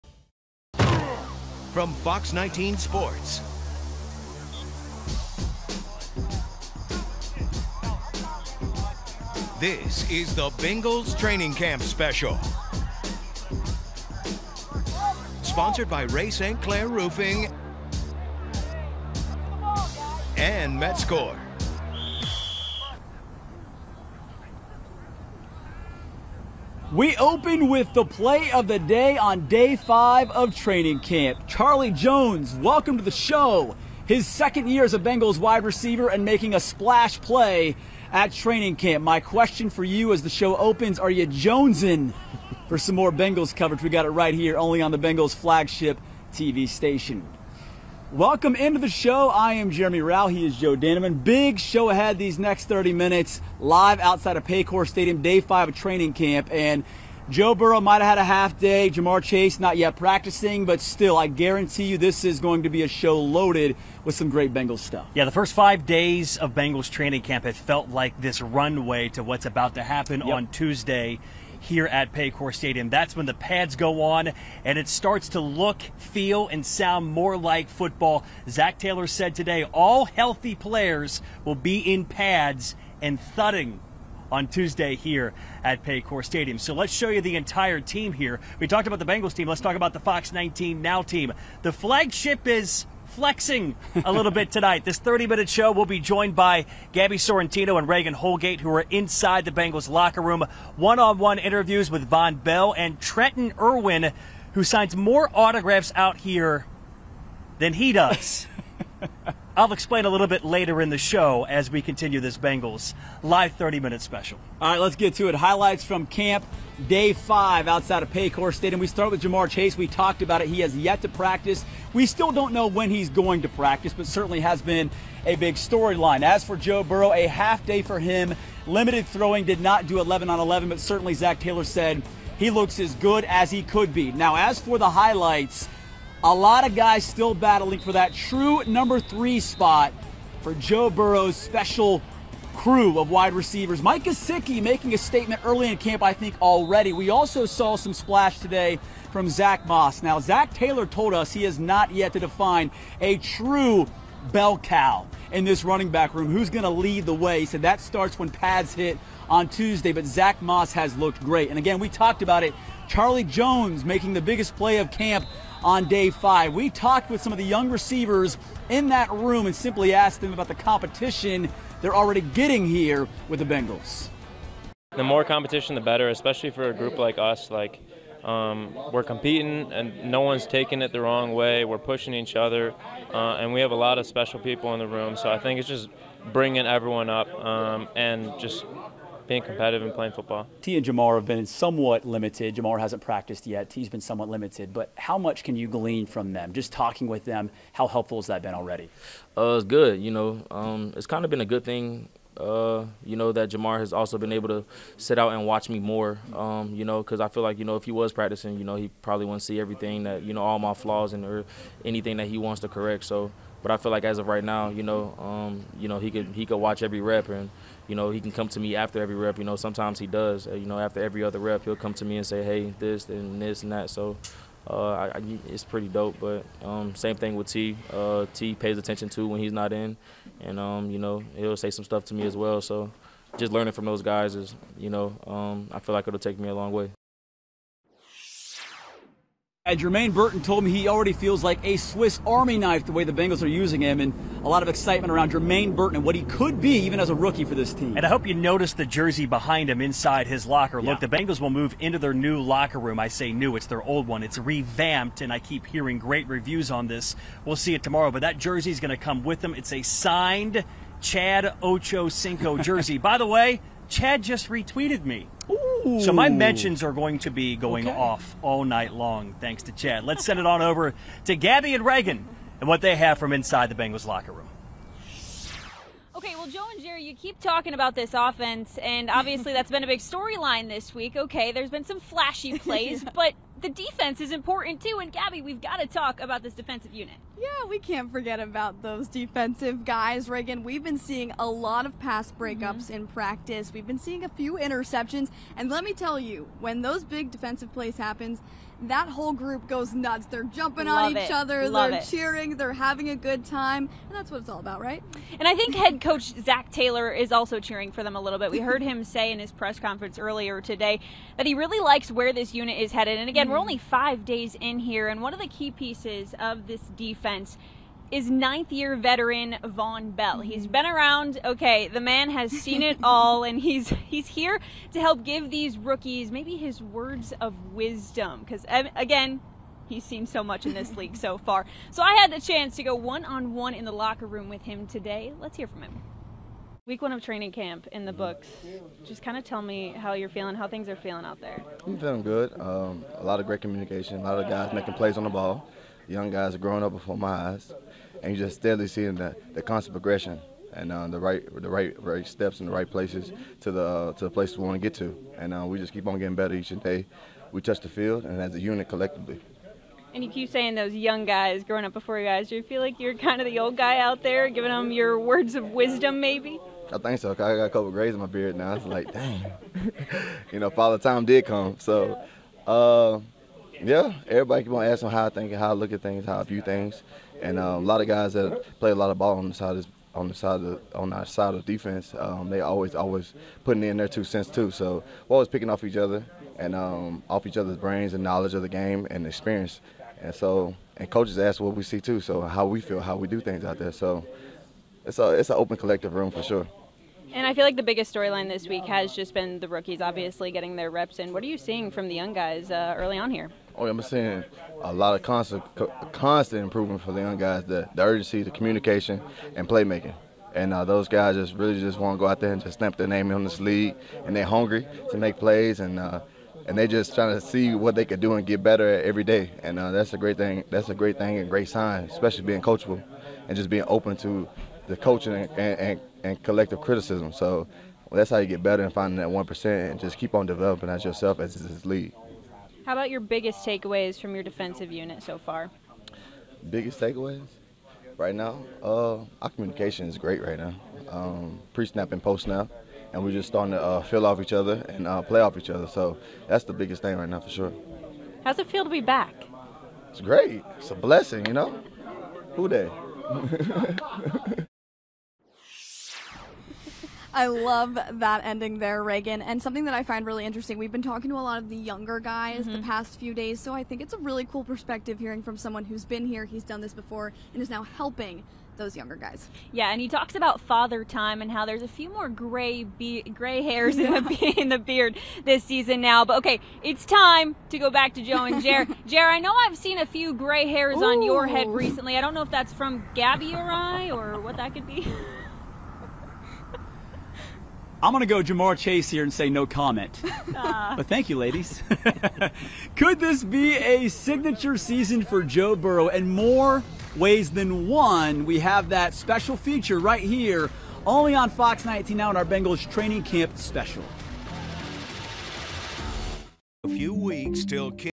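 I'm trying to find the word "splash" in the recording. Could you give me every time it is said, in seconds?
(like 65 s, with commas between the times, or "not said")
36 s, 147 s.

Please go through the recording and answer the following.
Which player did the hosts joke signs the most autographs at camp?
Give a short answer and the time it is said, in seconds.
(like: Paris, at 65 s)
Trenton Irwin, at 102 s.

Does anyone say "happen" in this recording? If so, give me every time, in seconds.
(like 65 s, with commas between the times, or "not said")
69 s, 297 s.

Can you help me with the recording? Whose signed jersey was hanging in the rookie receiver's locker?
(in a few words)
Chad Ocho Cinco.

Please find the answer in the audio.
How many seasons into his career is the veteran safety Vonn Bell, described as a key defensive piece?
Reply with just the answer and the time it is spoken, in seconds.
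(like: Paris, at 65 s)
9, at 318 s.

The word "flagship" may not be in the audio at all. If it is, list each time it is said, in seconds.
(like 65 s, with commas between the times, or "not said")
45 s, 91 s.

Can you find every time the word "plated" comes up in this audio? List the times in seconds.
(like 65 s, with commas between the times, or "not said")
not said.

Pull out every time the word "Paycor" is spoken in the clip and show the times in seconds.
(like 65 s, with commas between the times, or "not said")
54 s, 72 s, 85 s, 118 s.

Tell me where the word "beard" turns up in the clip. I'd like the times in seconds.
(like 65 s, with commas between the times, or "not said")
368 s, 474 s.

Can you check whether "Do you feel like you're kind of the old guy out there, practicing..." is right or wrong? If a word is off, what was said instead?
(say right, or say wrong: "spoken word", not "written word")
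wrong: "giving", not "practicing".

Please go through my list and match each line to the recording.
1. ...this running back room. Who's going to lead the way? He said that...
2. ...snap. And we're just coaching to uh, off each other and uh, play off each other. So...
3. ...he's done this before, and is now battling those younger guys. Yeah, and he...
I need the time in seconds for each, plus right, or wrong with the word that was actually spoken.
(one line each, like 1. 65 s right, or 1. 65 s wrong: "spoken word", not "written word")
1. 155 s right
2. 442 s wrong: "starting", not "coaching"
3. 466 s wrong: "helping", not "battling".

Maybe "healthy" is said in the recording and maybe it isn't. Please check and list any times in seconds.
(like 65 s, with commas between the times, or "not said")
80 s.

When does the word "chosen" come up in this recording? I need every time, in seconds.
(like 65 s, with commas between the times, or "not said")
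not said.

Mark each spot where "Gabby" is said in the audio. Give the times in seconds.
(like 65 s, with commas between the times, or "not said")
96 s, 271 s, 285 s, 483 s.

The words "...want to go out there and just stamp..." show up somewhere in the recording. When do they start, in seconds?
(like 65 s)
411 s.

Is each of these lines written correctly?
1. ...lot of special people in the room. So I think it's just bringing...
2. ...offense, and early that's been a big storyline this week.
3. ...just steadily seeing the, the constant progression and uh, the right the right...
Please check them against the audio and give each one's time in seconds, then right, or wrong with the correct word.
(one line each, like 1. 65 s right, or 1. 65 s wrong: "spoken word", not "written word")
1. 183 s right
2. 278 s wrong: "obviously", not "early"
3. 348 s right.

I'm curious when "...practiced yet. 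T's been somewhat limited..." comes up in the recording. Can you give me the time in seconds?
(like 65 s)
193 s.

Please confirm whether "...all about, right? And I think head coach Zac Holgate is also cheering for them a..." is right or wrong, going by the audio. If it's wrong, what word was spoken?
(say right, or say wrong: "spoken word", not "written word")
wrong: "Taylor", not "Holgate".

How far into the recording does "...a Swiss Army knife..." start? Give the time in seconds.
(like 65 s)
241 s.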